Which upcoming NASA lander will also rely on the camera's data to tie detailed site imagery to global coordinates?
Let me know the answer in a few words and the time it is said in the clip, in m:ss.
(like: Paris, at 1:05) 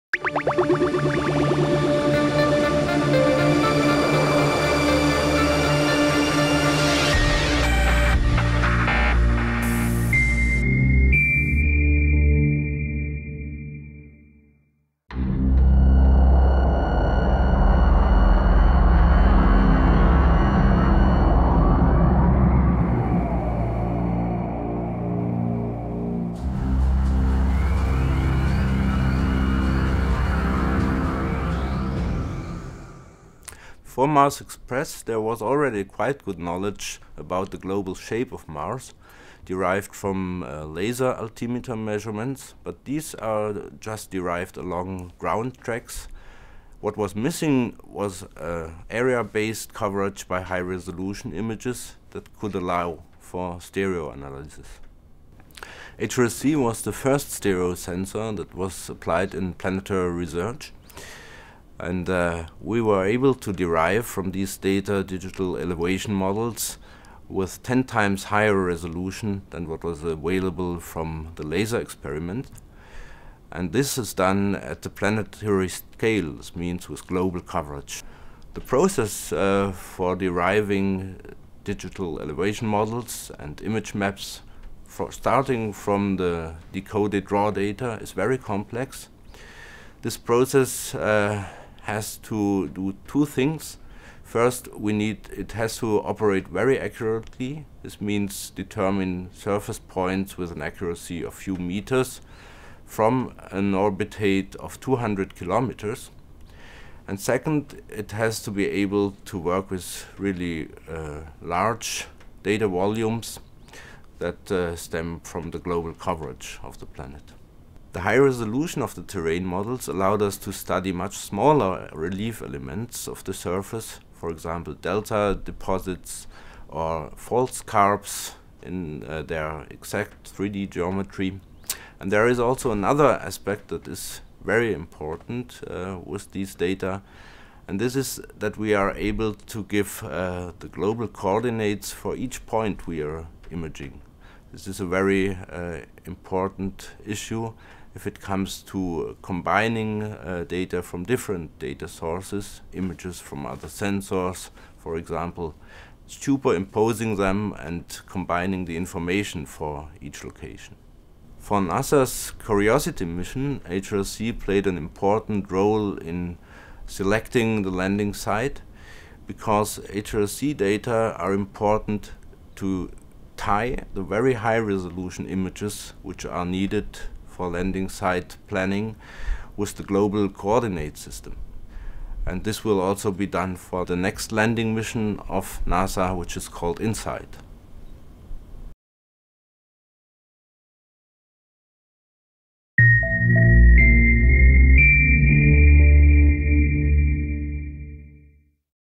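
InSight, at 3:06.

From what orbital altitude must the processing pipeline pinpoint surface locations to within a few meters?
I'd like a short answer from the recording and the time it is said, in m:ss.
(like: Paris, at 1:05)
200 kilometers, at 1:44.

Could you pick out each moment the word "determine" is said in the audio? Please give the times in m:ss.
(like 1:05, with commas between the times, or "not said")
1:38.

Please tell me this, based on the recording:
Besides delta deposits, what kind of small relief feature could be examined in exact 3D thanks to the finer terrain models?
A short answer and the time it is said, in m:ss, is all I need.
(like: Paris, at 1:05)
fault scarps, at 2:07.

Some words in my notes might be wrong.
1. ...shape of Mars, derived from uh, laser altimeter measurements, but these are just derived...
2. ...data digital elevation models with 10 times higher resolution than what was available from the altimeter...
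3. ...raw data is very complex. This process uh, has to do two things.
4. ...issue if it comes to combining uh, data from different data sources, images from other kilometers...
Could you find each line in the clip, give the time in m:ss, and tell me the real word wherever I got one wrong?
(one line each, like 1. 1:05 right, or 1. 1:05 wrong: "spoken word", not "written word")
1. 0:37 right
2. 1:04 wrong: "laser", not "altimeter"
3. 1:27 right
4. 2:27 wrong: "sensors", not "kilometers".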